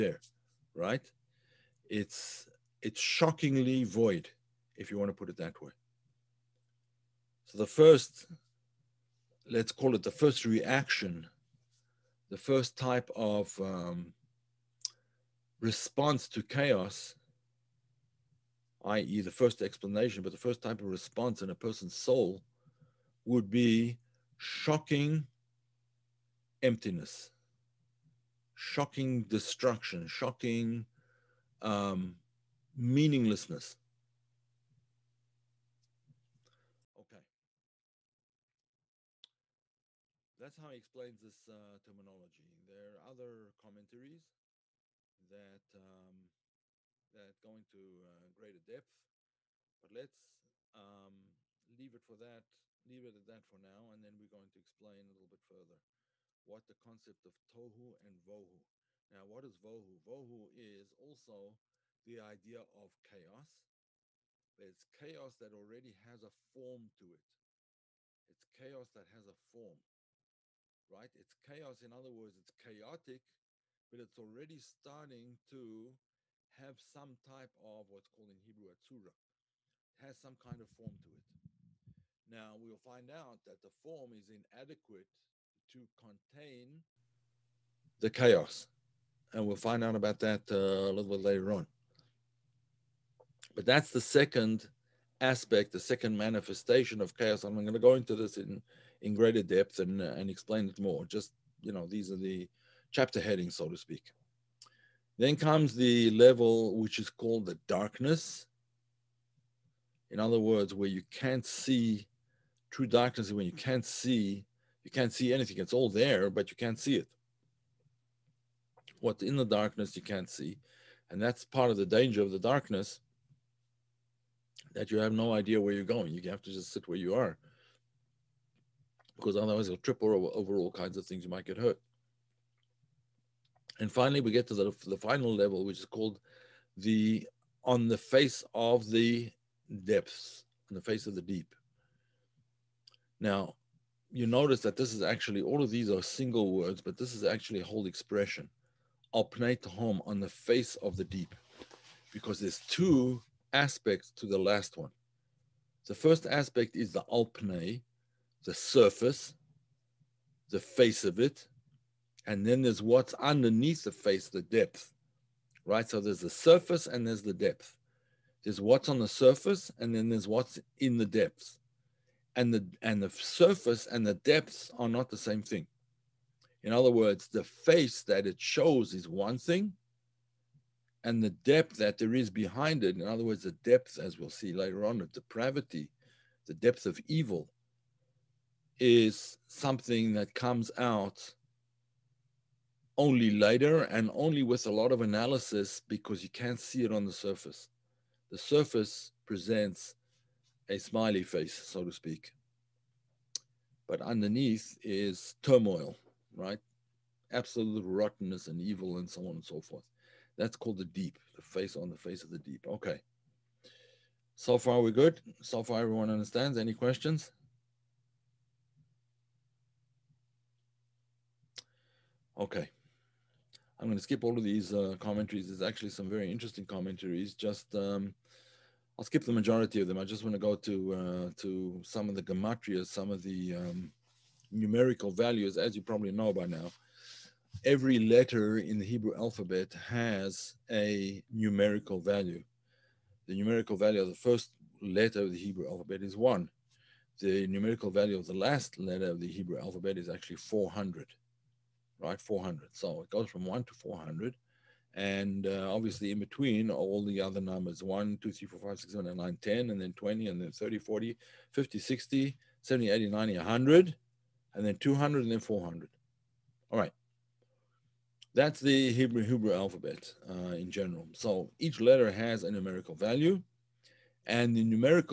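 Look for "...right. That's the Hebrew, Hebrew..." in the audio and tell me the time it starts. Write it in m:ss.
4:26.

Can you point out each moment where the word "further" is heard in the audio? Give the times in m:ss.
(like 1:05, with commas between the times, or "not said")
0:55.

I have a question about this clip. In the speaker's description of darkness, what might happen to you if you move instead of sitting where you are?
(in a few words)
You might get hurt.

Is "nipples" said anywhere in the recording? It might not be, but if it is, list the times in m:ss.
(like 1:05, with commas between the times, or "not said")
not said.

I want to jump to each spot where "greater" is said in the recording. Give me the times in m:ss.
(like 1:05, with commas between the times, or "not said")
0:48, 1:39.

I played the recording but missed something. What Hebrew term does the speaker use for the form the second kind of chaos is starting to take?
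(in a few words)
atzura.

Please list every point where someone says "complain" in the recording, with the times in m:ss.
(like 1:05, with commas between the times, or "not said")
not said.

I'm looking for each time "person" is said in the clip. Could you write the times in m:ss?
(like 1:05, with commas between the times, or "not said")
0:21.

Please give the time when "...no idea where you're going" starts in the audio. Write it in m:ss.
2:05.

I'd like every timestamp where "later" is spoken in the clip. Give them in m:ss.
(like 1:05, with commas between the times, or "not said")
1:31, 3:04, 3:13.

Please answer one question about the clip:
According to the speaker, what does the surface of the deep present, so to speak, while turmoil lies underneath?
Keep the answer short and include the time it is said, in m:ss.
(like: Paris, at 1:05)
a smiley face, at 3:20.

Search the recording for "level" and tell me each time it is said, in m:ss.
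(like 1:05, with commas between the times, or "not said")
1:46, 2:15.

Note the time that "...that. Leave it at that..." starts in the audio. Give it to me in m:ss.
0:52.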